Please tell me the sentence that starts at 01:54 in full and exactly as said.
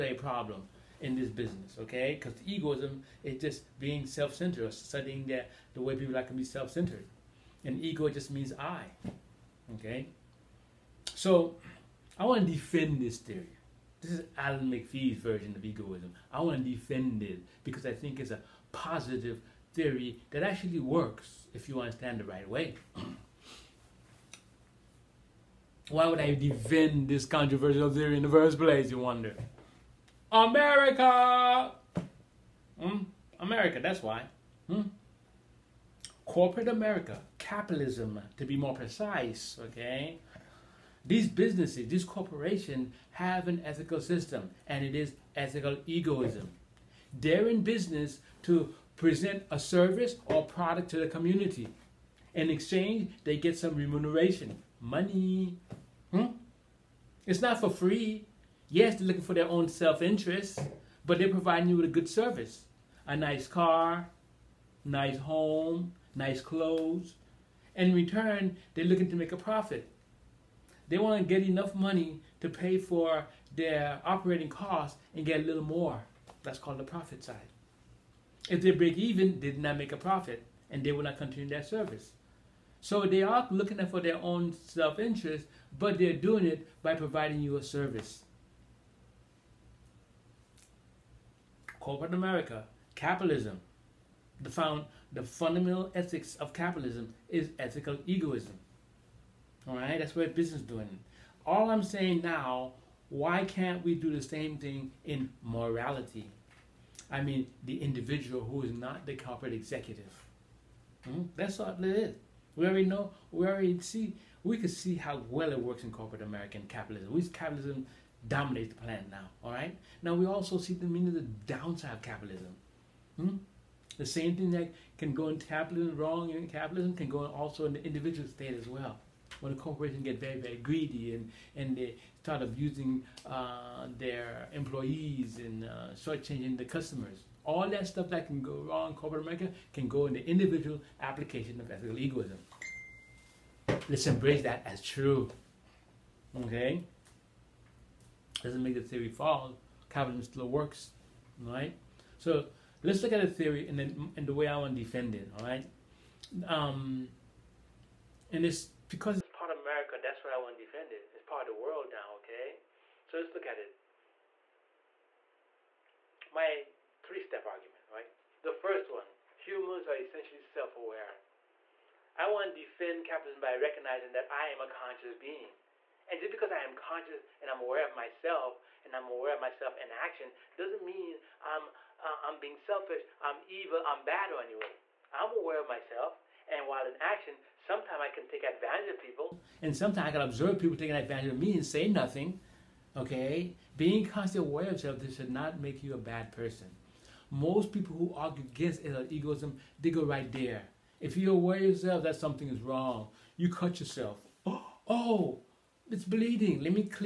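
We can see how well it works in corporate American capitalism.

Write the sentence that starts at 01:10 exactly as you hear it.
They want to get enough money to pay for their operating costs and get a little more.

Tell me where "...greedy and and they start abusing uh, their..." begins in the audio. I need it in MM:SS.
02:10.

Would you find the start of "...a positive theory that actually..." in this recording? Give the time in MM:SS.
00:18.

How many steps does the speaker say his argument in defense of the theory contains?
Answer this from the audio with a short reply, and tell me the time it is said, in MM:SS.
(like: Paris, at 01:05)
3, at 02:47.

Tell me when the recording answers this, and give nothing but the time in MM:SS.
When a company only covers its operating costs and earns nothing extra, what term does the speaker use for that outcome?
01:18.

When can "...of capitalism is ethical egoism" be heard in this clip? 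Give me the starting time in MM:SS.
01:36.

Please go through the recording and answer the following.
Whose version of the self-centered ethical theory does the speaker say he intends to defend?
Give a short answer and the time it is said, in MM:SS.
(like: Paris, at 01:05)
Alan McPhee, at 00:14.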